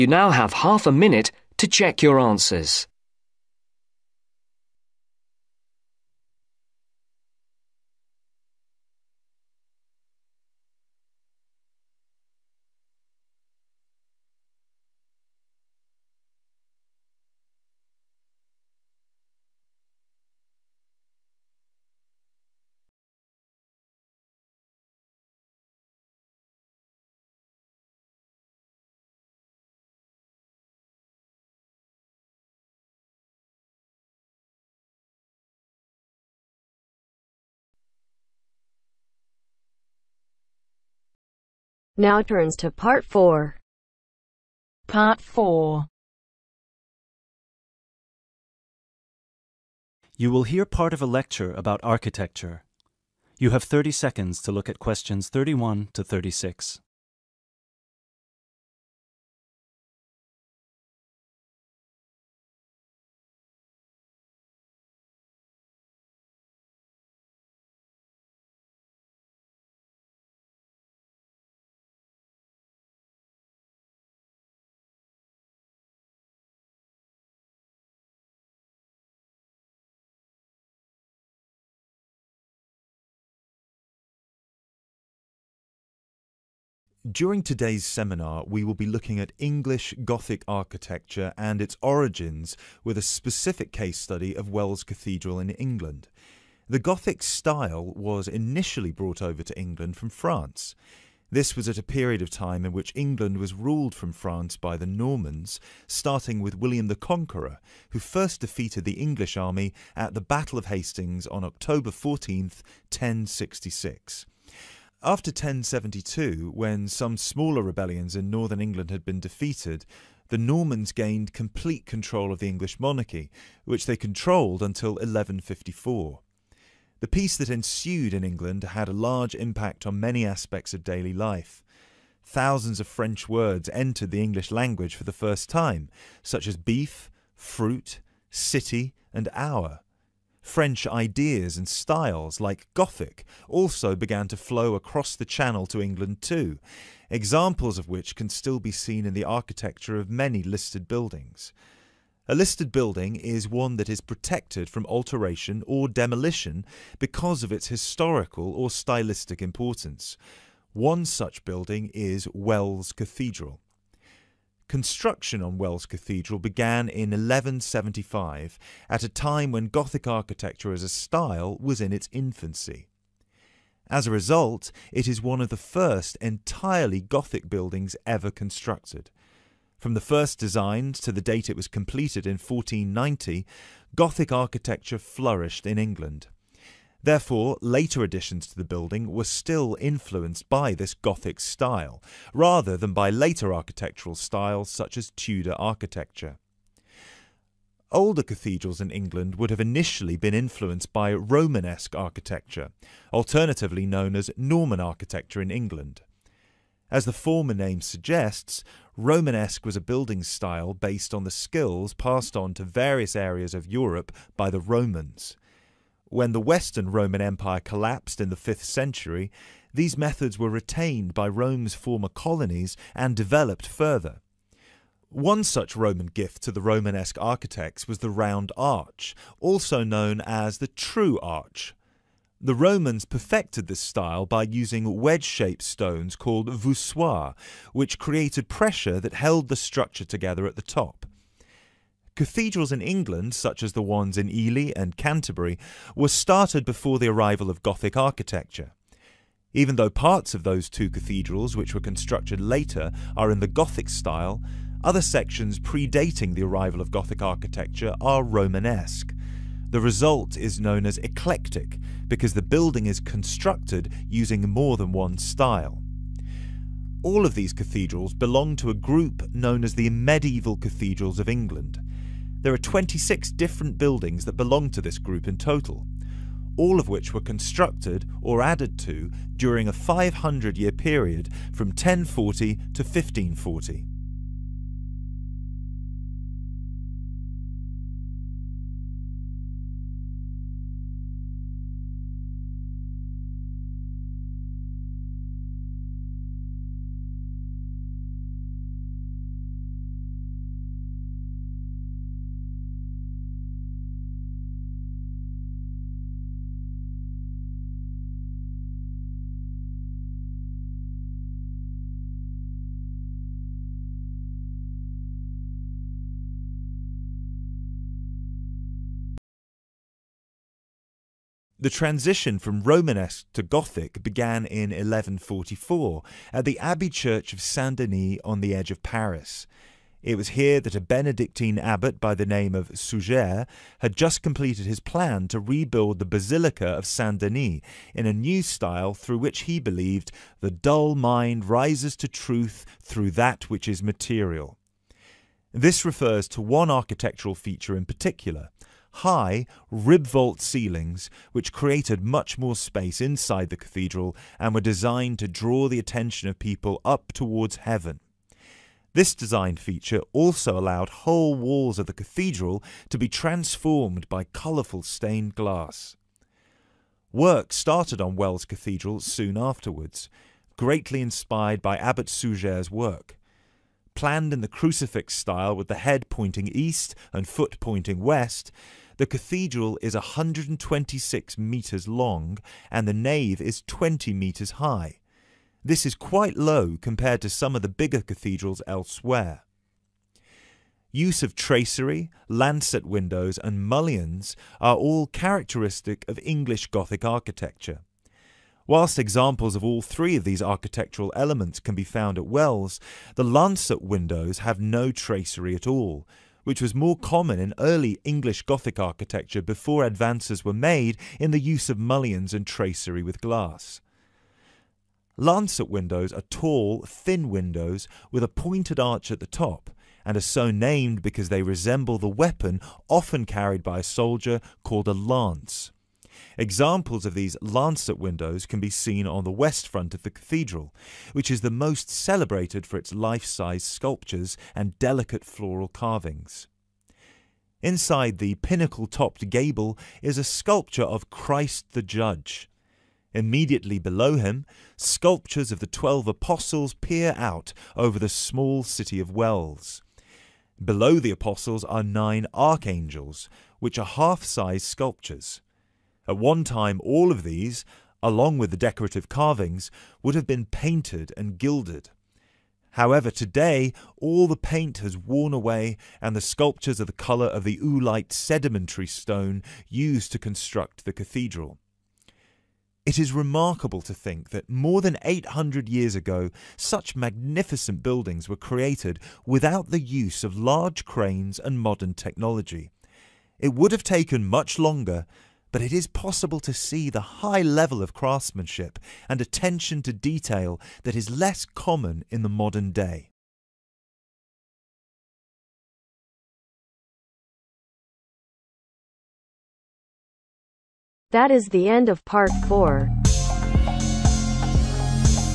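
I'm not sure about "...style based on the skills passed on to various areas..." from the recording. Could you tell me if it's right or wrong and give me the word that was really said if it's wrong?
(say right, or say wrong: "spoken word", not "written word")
right.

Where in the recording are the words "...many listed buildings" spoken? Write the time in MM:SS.
02:30.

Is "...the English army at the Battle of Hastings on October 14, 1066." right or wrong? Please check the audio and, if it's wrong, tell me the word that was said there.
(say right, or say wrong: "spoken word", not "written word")
right.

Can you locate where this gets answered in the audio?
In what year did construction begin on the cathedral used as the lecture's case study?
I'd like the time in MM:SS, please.
02:47.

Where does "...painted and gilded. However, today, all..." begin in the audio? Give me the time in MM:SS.
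07:40.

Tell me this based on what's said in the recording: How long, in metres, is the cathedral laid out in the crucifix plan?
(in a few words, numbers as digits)
126 metres.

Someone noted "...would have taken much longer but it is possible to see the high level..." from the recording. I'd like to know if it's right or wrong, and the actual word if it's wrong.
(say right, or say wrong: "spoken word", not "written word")
right.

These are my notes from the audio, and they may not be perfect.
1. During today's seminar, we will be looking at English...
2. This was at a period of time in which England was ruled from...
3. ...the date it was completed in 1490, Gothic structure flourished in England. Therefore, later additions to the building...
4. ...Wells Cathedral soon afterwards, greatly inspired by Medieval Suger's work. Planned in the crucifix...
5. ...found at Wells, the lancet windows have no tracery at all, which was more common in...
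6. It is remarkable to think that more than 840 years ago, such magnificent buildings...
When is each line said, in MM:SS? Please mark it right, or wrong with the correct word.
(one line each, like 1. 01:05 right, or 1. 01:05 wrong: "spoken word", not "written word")
1. 01:27 right
2. 01:41 right
3. 03:01 wrong: "architecture", not "structure"
4. 06:08 wrong: "Abbot", not "Medieval"
5. 06:41 right
6. 07:52 wrong: "800", not "840".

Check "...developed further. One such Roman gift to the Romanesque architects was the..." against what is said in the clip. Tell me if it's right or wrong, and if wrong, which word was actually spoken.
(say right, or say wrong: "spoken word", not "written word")
right.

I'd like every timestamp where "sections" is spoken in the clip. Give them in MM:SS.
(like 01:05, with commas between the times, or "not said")
04:15.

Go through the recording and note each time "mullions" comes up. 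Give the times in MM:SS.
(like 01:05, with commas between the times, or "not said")
06:33, 06:51.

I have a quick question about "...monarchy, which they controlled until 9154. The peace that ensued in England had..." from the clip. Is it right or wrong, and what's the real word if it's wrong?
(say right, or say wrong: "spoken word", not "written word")
wrong: "1154", not "9154".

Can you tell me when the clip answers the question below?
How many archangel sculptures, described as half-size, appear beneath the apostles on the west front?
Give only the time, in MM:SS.
07:31.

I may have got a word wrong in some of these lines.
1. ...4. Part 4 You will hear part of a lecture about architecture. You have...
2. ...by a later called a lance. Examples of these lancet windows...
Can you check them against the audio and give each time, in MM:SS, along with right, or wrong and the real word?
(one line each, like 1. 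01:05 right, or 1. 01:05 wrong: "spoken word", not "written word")
1. 00:43 right
2. 07:03 wrong: "soldier", not "later".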